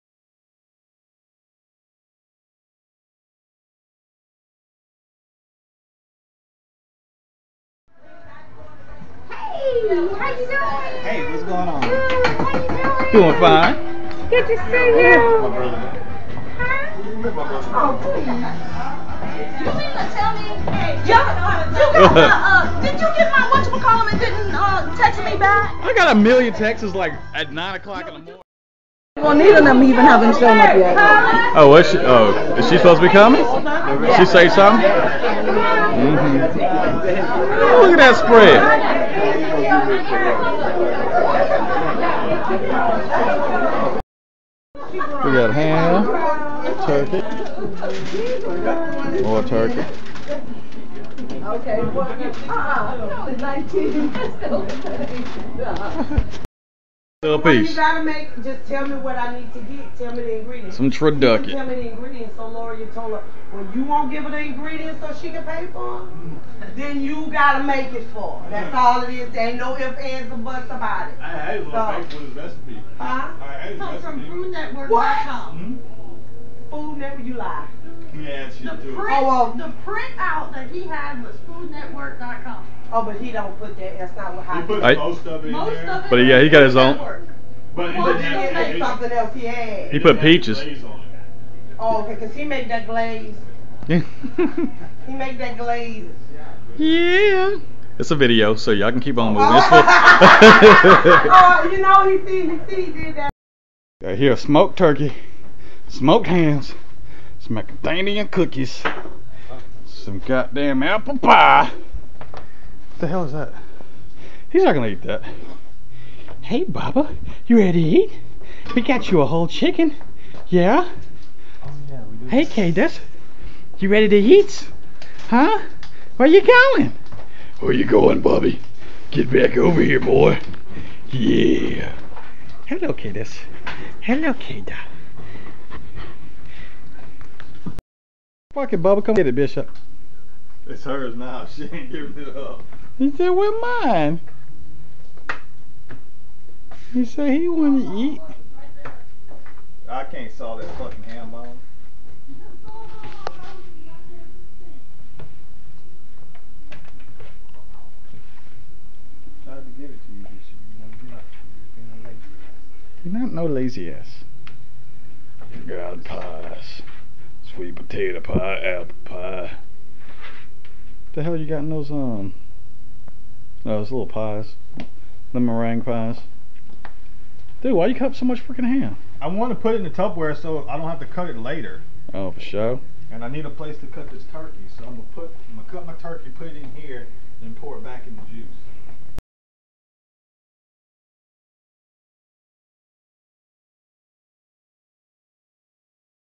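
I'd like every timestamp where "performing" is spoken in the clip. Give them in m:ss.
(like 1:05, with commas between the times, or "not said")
not said.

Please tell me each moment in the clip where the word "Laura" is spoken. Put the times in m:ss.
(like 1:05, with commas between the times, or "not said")
1:02.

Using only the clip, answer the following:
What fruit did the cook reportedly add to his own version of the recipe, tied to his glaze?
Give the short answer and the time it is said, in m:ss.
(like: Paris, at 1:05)
Peaches, at 1:30.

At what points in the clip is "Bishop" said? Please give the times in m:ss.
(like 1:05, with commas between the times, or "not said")
2:19, 2:40.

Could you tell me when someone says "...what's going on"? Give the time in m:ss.
0:11.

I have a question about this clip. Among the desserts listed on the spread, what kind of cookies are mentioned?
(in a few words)
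Macadamia cookies.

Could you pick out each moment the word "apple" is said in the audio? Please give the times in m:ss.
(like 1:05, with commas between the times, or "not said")
1:50, 2:48.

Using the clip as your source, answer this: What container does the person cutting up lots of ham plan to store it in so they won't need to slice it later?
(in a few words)
Tupperware.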